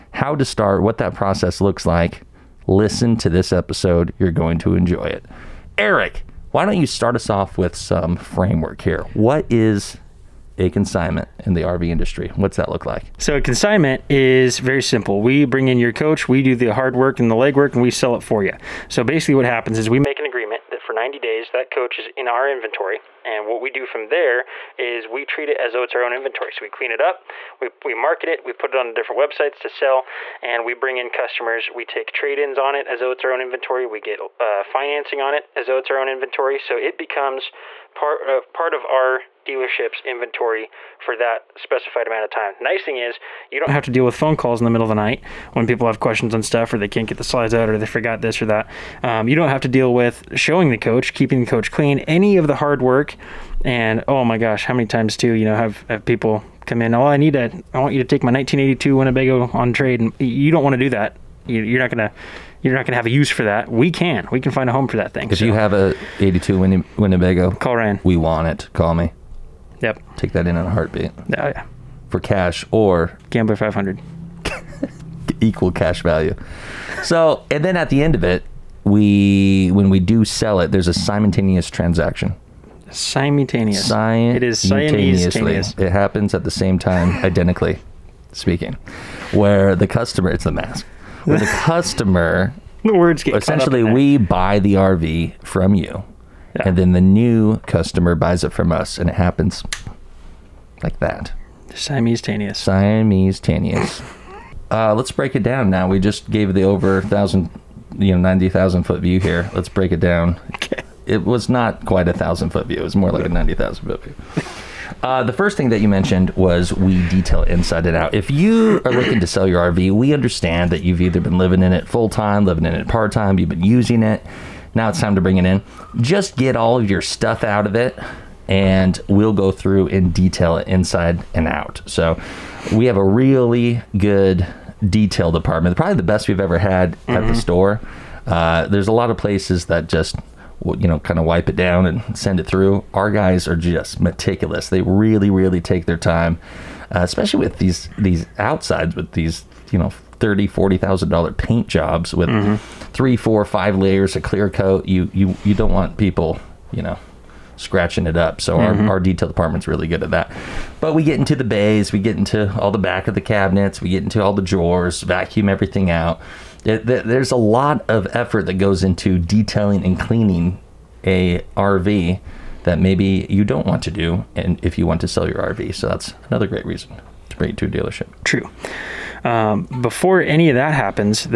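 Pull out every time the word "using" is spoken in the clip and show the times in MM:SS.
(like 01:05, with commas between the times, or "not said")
02:03.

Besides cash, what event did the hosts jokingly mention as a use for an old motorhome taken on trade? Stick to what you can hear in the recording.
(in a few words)
Gambler 500.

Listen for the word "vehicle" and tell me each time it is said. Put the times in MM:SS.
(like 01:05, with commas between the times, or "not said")
not said.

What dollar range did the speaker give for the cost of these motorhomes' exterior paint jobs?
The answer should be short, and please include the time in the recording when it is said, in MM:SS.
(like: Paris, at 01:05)
$30,000 to $40,000, at 02:30.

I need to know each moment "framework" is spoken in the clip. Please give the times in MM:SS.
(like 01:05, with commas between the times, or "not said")
00:08.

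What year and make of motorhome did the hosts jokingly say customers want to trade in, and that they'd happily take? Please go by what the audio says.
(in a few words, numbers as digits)
1982 Winnebago.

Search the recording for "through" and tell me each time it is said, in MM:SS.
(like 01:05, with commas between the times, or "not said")
02:09, 02:22.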